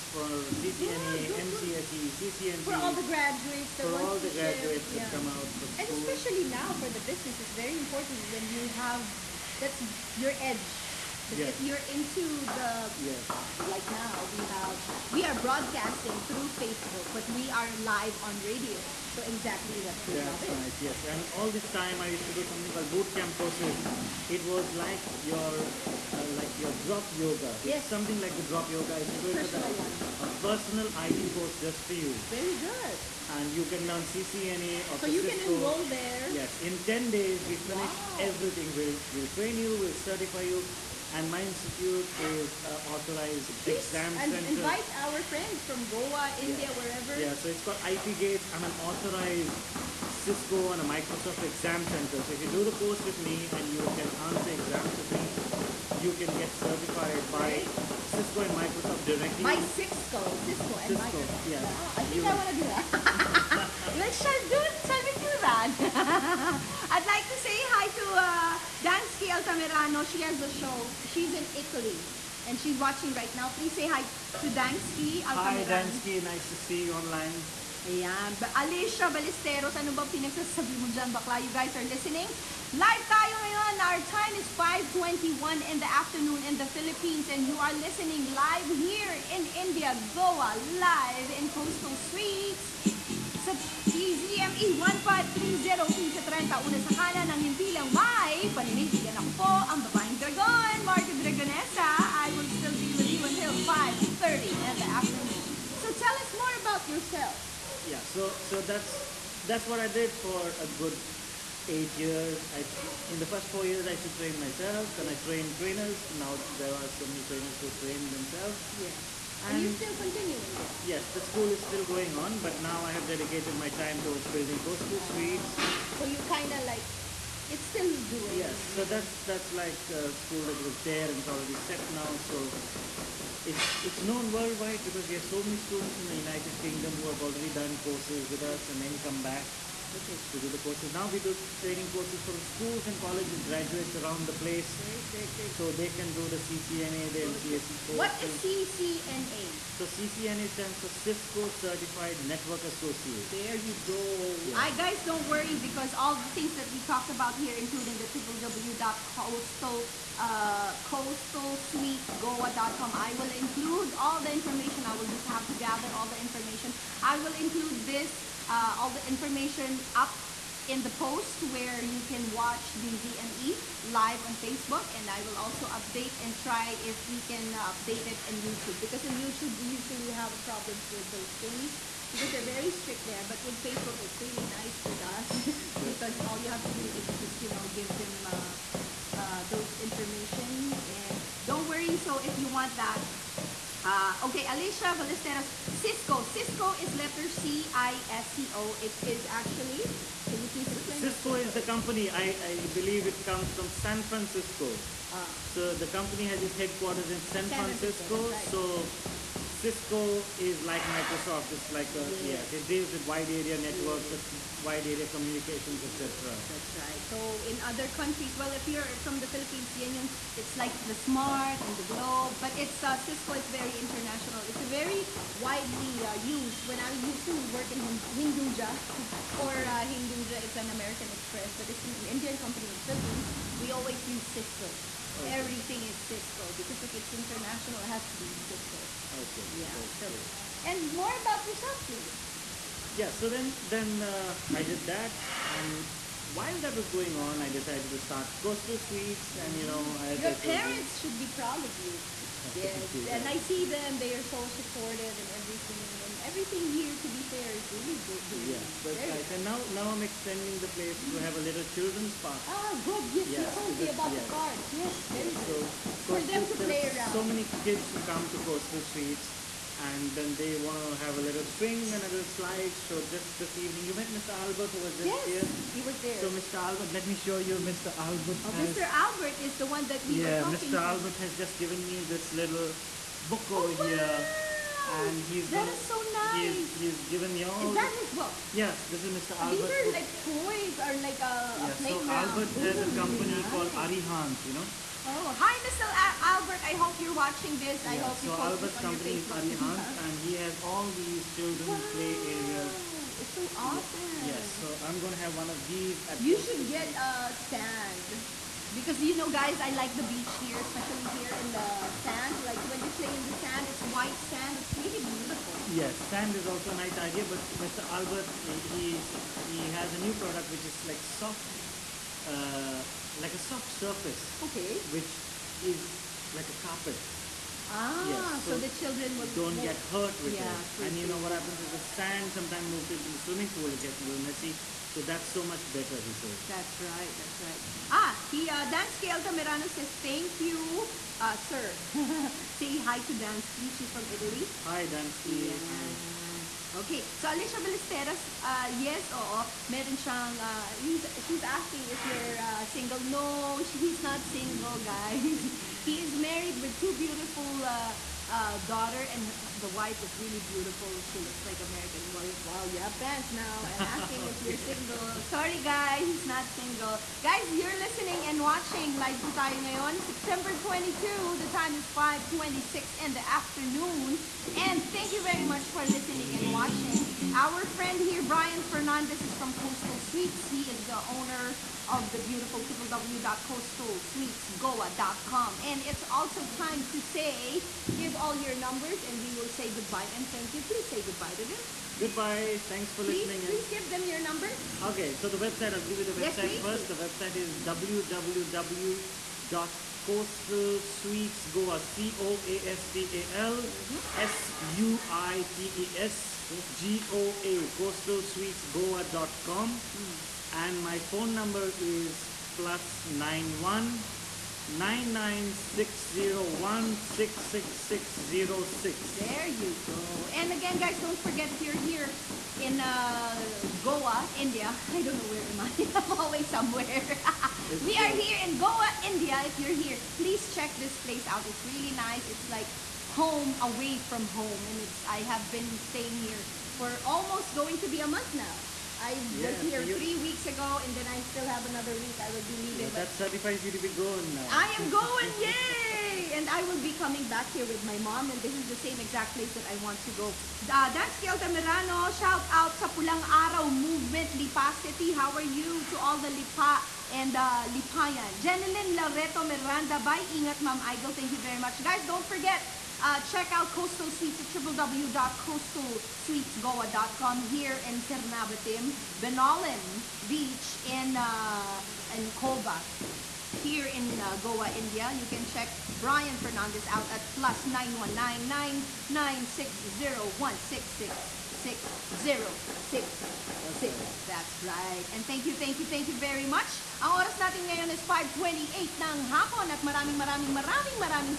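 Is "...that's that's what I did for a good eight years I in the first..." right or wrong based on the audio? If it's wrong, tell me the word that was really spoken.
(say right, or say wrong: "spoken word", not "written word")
right.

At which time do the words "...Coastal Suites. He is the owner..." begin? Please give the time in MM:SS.
06:19.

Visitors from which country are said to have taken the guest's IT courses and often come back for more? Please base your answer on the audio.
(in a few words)
United Kingdom.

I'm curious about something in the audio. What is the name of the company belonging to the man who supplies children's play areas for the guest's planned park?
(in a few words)
Arihant.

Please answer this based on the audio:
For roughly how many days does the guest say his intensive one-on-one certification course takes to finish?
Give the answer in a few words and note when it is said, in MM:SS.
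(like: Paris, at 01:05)
10 days, at 00:36.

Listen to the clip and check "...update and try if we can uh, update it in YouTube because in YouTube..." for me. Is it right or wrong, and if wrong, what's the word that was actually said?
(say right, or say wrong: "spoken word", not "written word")
right.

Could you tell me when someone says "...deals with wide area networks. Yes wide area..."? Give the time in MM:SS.
03:32.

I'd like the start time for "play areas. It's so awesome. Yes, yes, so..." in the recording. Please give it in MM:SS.
05:01.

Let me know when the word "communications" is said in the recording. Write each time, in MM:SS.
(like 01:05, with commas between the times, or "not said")
03:35.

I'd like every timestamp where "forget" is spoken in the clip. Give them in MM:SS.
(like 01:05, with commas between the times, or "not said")
07:01, 07:42.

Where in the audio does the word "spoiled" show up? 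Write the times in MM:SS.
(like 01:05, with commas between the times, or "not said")
not said.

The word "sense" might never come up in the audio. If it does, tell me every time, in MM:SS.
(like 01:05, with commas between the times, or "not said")
not said.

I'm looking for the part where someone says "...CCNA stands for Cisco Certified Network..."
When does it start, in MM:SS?
02:29.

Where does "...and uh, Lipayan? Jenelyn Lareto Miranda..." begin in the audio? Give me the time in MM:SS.
07:37.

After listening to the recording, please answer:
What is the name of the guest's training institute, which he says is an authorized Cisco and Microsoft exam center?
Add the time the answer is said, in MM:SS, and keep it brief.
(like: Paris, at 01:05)
IP Gates, at 00:47.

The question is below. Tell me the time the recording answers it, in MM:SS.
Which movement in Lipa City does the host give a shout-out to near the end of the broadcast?
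07:32.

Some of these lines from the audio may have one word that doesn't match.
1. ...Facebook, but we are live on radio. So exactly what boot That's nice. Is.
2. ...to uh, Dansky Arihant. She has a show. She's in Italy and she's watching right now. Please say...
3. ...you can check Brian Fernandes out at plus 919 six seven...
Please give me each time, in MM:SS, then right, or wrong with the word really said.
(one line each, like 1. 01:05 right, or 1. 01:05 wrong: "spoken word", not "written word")
1. 00:16 right
2. 01:07 wrong: "Altamirano", not "Arihant"
3. 07:55 wrong: "six", not "seven".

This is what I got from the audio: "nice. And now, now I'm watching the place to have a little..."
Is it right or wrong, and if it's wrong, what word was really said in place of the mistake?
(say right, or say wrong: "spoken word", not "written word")
wrong: "extending", not "watching".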